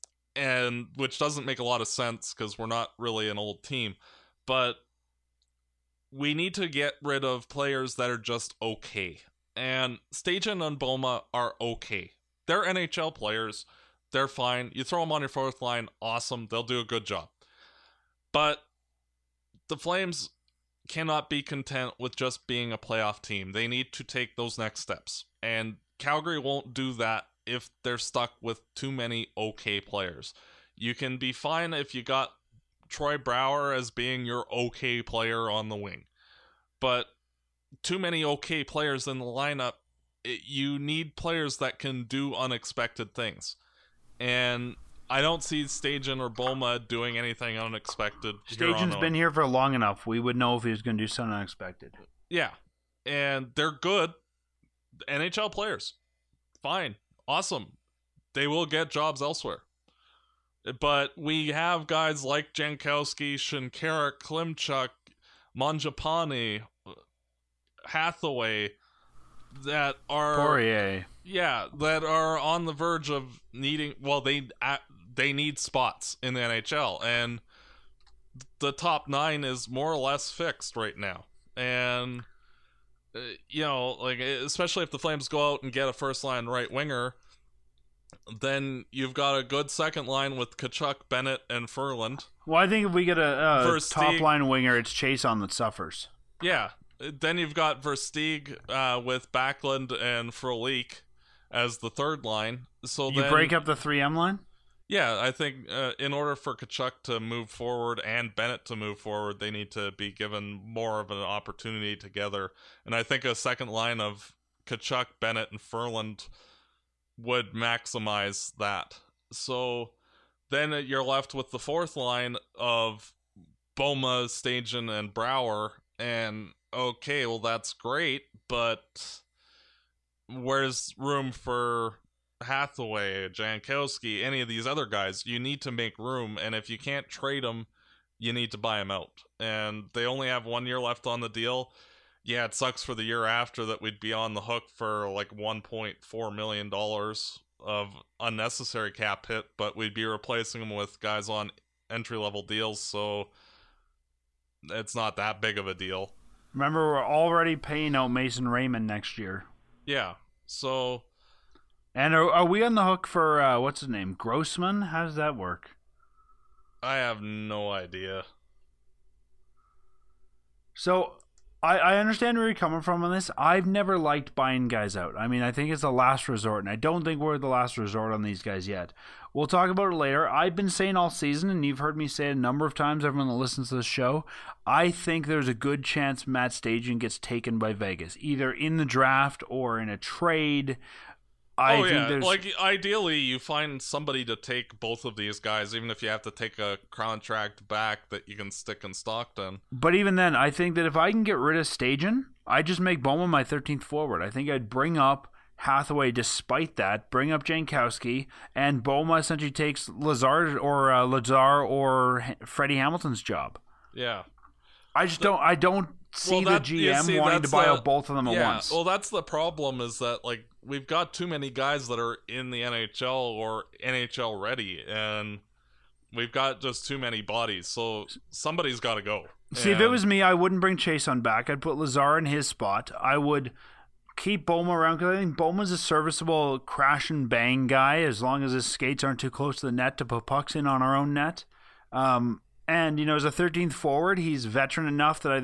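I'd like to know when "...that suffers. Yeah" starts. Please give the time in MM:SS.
01:35.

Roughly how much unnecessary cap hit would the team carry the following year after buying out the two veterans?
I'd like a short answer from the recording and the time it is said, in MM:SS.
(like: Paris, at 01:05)
$1.4 million, at 02:25.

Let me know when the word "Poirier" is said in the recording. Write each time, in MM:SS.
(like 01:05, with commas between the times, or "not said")
01:10.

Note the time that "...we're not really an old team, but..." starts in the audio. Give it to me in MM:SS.
00:02.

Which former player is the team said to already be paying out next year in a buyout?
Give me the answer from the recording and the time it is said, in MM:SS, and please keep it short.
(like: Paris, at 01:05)
Mason Raymond, at 02:38.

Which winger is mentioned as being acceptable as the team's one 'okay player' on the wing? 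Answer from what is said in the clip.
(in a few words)
Troy Brouwer.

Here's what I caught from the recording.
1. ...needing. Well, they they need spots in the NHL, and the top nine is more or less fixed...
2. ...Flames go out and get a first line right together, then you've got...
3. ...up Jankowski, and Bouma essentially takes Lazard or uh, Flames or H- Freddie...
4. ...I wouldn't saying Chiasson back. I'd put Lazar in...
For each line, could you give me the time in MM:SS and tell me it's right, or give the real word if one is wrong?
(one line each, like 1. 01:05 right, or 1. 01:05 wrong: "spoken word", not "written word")
1. 01:13 right
2. 01:24 wrong: "winger", not "together"
3. 03:27 wrong: "Lazar", not "Flames"
4. 03:50 wrong: "bring", not "saying".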